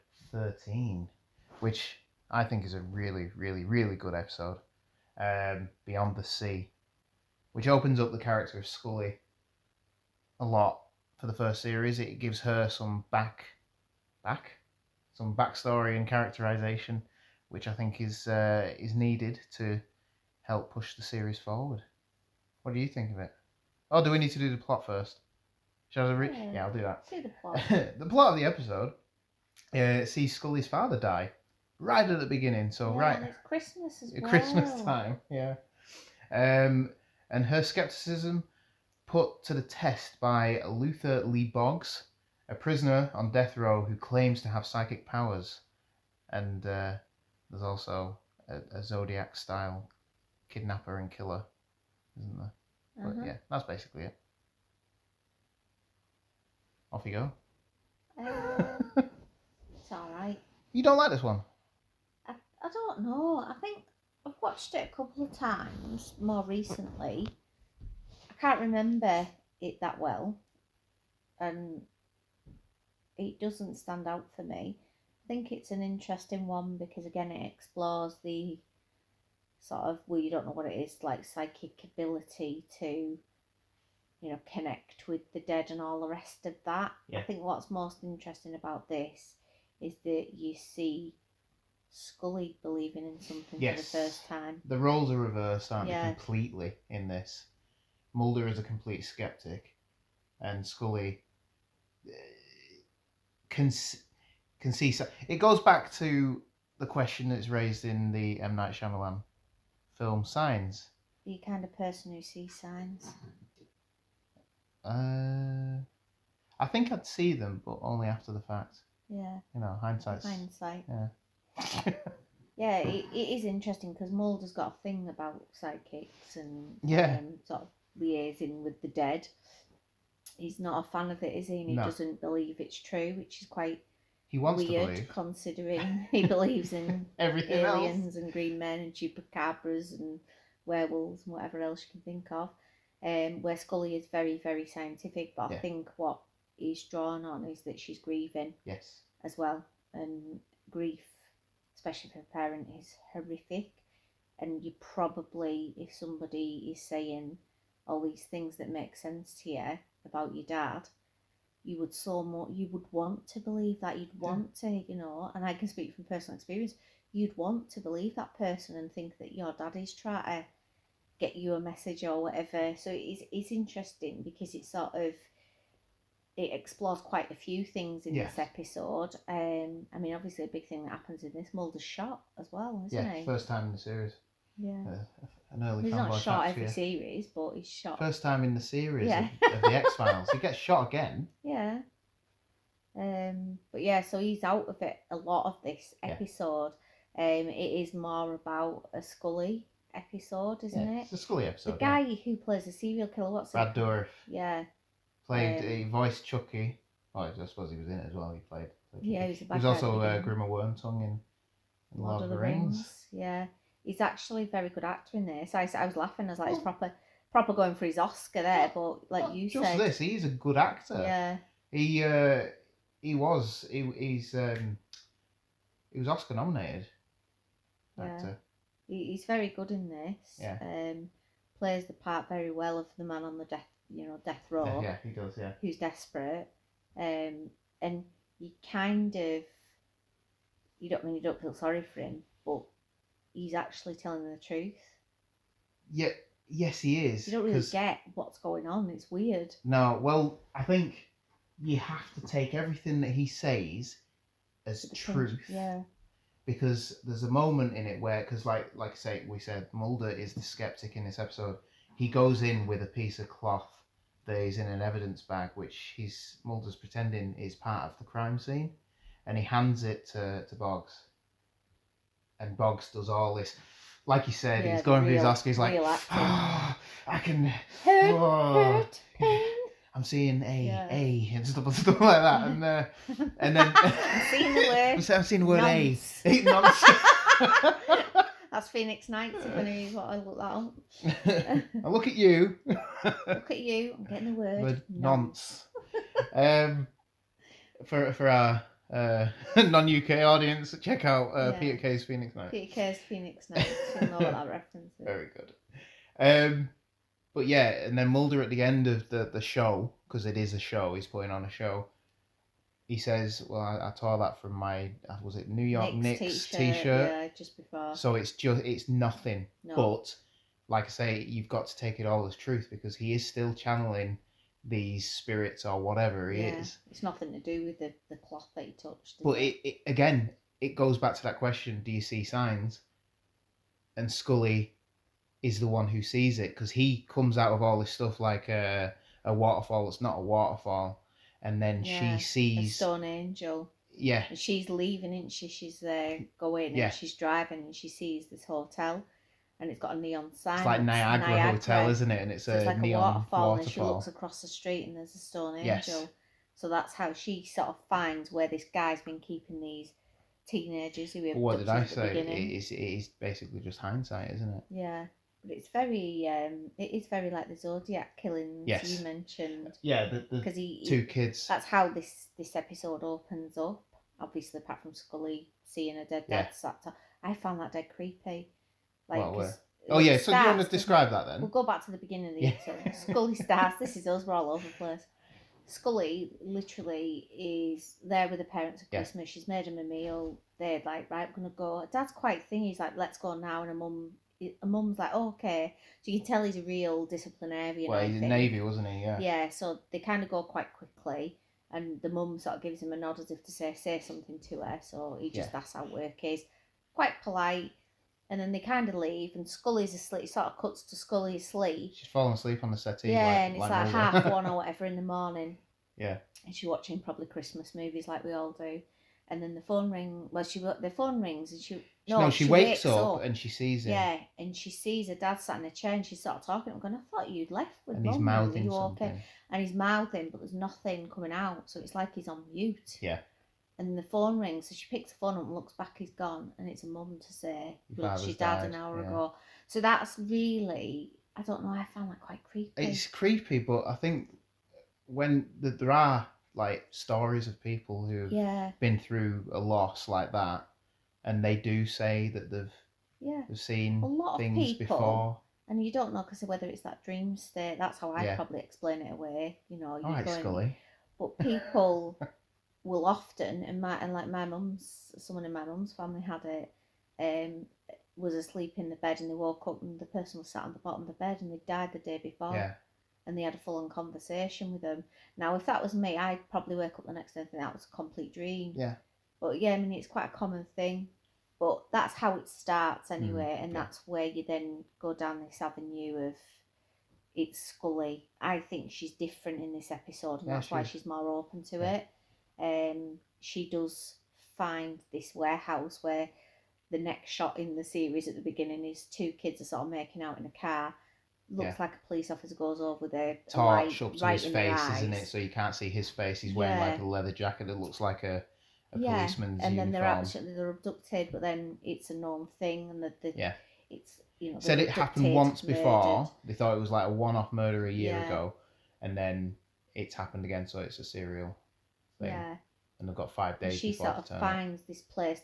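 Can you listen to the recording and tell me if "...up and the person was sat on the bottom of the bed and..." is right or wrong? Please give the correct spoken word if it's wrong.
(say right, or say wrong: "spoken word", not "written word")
right.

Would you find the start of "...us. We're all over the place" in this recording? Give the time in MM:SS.
06:24.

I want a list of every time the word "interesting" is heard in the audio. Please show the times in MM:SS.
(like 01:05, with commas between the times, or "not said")
01:15, 01:28, 02:03, 02:53.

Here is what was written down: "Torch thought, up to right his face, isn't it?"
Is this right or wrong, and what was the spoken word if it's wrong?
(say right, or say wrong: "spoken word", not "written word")
wrong: "light", not "thought".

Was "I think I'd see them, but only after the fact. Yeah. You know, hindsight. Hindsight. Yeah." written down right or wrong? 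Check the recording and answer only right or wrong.
right.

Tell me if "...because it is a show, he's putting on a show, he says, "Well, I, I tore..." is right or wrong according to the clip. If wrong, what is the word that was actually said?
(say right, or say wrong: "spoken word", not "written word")
right.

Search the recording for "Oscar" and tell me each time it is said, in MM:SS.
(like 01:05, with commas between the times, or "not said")
03:37, 03:46, 04:35.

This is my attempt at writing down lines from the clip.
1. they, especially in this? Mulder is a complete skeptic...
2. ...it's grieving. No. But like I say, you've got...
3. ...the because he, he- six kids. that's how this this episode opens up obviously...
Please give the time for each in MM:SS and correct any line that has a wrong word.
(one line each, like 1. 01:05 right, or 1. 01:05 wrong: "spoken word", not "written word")
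1. 01:36 wrong: "completely", not "especially"
2. 05:18 wrong: "nothing", not "grieving"
3. 06:10 wrong: "two", not "six".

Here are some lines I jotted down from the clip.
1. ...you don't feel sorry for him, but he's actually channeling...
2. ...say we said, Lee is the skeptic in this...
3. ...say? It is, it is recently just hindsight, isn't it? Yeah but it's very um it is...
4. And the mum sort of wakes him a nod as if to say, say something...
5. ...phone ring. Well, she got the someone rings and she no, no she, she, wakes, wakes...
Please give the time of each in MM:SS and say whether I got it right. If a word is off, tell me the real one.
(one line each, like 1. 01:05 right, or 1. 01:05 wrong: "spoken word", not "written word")
1. 04:01 wrong: "telling", not "channeling"
2. 04:18 wrong: "Mulder", not "Lee"
3. 06:01 wrong: "basically", not "recently"
4. 06:41 wrong: "gives", not "wakes"
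5. 06:59 wrong: "phone", not "someone".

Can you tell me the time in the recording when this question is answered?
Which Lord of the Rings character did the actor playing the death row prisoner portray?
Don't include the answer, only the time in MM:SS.
03:30.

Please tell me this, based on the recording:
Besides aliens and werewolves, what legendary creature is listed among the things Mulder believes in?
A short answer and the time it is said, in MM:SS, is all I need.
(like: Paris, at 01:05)
Chupacabras, at 02:18.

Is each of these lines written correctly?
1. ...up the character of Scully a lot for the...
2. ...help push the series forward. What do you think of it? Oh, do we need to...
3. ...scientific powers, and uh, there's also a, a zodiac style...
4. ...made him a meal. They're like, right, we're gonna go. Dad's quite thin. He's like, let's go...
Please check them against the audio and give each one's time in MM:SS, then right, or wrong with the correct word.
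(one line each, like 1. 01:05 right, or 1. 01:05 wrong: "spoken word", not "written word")
1. 00:07 right
2. 00:20 right
3. 00:44 wrong: "psychic", not "scientific"
4. 06:29 right.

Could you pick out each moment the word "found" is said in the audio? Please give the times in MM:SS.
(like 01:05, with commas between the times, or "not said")
06:17, 07:21.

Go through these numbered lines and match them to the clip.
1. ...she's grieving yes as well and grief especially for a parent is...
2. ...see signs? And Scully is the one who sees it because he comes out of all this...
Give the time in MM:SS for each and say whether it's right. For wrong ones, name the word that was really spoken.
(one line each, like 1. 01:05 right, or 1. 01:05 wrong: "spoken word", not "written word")
1. 02:27 right
2. 05:32 right.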